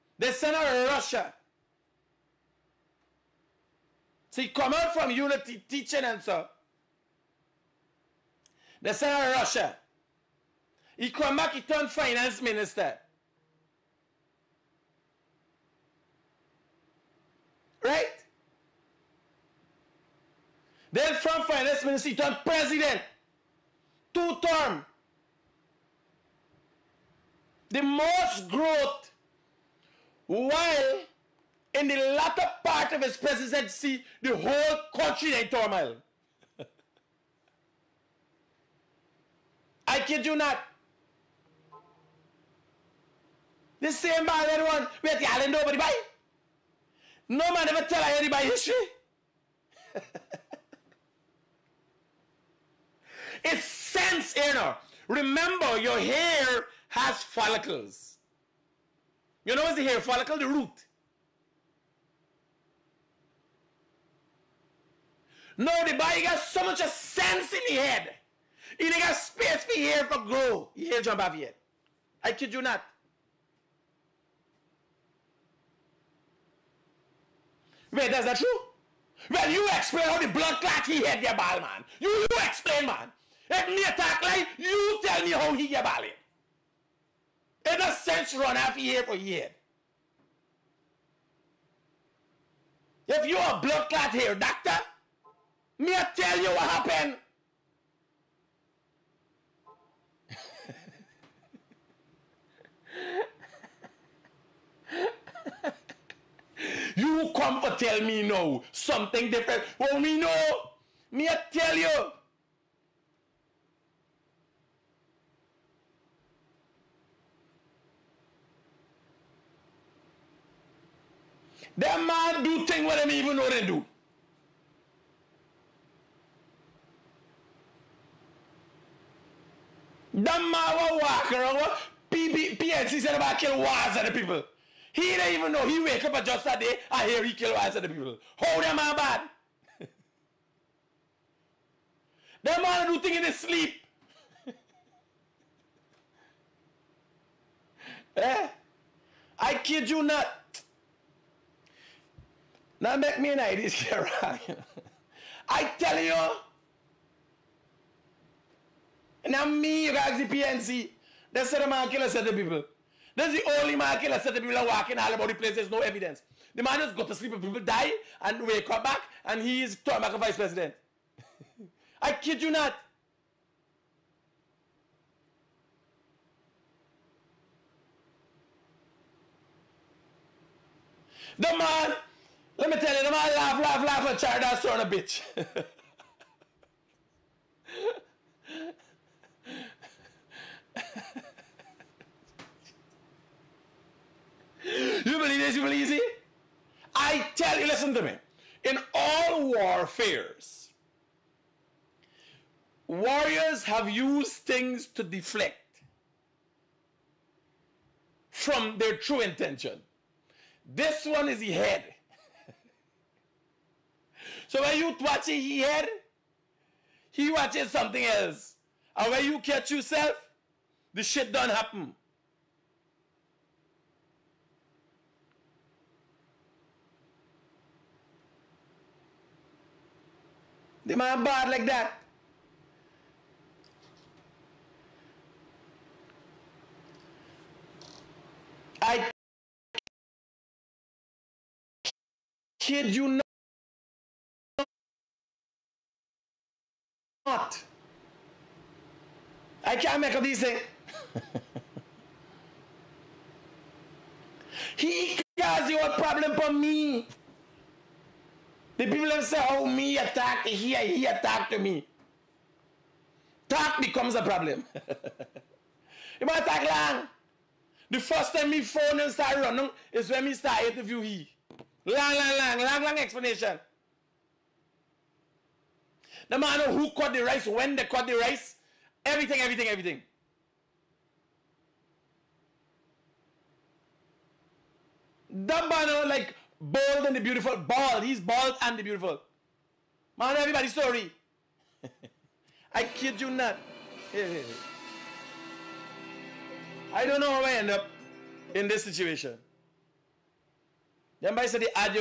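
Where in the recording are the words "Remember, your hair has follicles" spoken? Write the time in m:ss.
0:55.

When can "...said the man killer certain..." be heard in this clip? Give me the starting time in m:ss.
2:41.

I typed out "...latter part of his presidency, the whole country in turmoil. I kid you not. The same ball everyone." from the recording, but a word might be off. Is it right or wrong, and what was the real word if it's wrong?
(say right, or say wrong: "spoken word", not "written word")
right.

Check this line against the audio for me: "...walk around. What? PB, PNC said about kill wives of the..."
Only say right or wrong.
right.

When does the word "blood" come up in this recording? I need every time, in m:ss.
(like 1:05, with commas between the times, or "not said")
1:20, 1:33.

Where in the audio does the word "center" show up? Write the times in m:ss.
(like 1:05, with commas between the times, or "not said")
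0:00, 0:08.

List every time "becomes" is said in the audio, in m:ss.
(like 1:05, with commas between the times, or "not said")
4:23.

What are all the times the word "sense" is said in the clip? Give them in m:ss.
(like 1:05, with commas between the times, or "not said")
0:53, 1:06, 1:27.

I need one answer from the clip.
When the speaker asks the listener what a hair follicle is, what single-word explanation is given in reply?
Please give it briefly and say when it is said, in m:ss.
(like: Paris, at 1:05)
The root, at 1:00.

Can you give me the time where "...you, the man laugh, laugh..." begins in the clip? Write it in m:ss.
3:02.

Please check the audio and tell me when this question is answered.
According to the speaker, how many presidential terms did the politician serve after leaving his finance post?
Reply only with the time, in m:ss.
0:24.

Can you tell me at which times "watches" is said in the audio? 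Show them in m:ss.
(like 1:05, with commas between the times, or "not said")
3:37.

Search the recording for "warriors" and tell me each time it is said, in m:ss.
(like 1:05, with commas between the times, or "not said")
3:22.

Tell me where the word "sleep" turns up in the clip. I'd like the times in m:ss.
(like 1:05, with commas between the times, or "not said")
2:23, 2:47.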